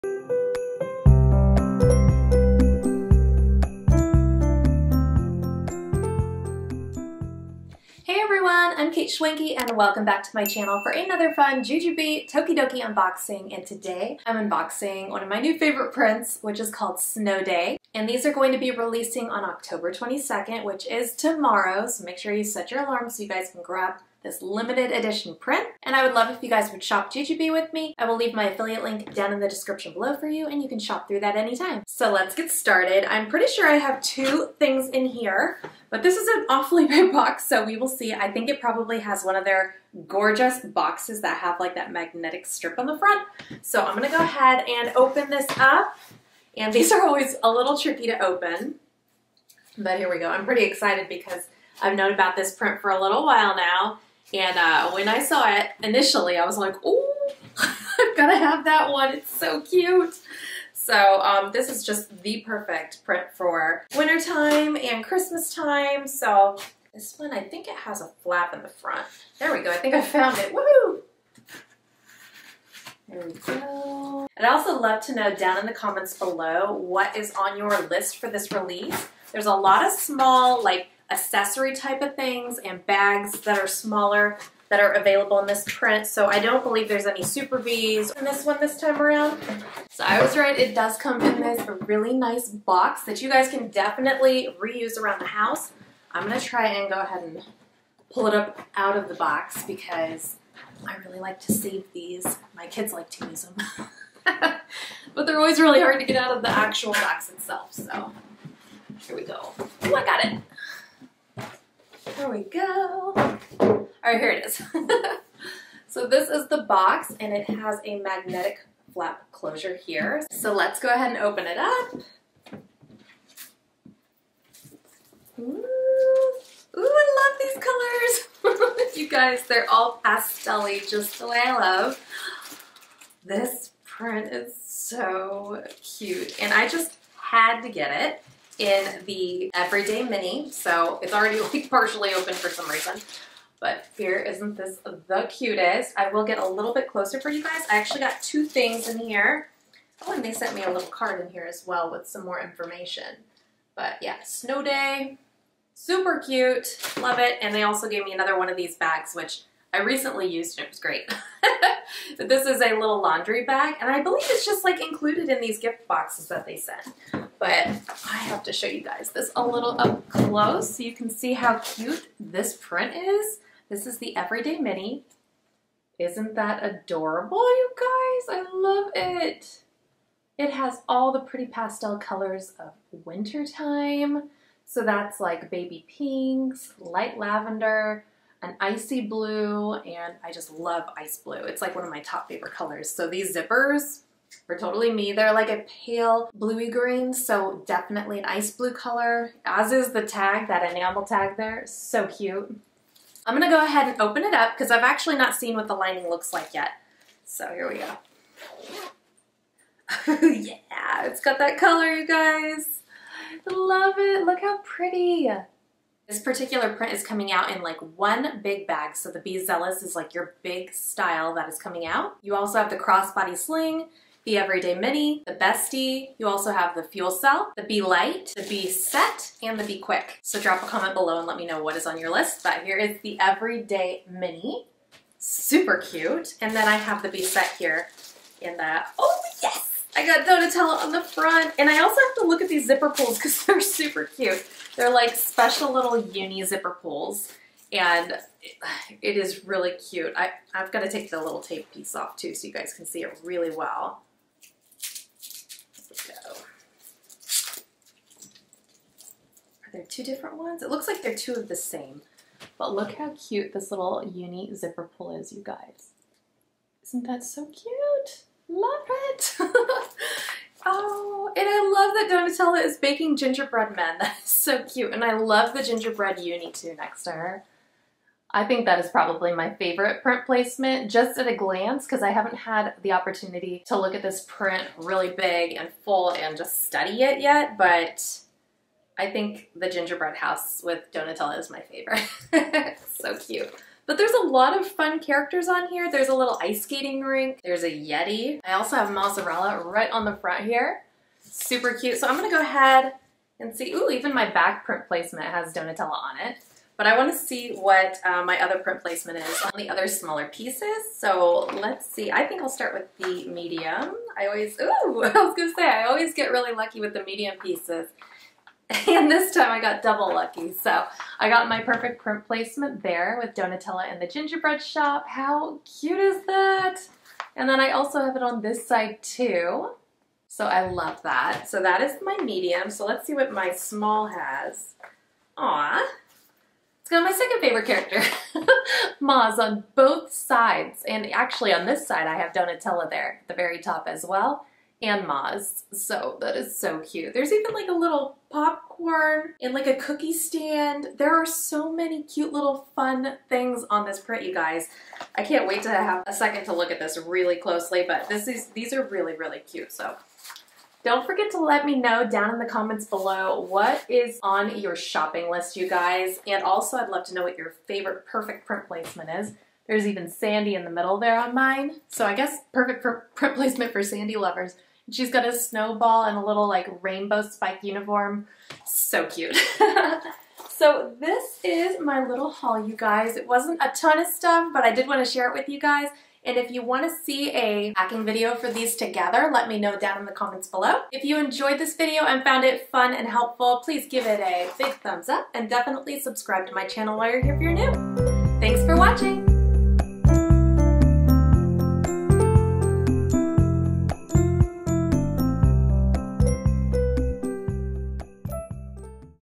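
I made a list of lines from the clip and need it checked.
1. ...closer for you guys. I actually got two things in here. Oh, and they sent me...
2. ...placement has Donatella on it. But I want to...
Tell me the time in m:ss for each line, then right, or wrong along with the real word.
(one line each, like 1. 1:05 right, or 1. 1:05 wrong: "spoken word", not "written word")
1. 2:26 right
2. 5:04 right.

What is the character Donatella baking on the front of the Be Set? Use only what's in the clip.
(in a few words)
gingerbread men.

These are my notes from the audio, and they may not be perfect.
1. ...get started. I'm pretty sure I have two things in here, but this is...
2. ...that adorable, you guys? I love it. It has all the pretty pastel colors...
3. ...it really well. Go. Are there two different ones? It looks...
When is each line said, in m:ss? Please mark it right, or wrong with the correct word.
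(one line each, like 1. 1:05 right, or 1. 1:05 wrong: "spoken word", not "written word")
1. 0:32 right
2. 2:56 right
3. 4:13 right.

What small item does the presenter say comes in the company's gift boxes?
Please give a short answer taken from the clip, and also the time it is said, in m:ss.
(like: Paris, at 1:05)
laundry bag, at 2:43.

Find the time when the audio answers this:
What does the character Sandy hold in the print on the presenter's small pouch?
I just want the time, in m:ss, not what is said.
6:15.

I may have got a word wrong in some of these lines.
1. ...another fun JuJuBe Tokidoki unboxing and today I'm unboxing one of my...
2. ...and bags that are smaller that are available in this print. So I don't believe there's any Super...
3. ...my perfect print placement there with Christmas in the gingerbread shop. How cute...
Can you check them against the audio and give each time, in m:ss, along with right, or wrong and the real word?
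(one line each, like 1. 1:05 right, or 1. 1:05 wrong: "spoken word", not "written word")
1. 0:10 right
2. 1:22 right
3. 5:21 wrong: "Donatella", not "Christmas".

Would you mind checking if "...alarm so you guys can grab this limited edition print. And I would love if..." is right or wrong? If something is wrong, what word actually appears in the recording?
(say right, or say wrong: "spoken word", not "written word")
right.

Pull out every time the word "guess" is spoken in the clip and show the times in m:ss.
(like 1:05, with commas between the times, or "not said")
6:12.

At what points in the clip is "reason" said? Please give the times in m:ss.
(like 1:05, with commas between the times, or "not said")
2:22.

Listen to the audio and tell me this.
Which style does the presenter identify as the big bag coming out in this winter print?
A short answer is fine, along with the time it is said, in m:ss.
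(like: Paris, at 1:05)
Be Zealous, at 3:39.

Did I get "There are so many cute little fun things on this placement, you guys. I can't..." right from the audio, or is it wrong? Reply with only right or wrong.
wrong.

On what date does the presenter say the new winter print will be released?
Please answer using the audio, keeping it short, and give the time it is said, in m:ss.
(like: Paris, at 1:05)
October 22, at 0:19.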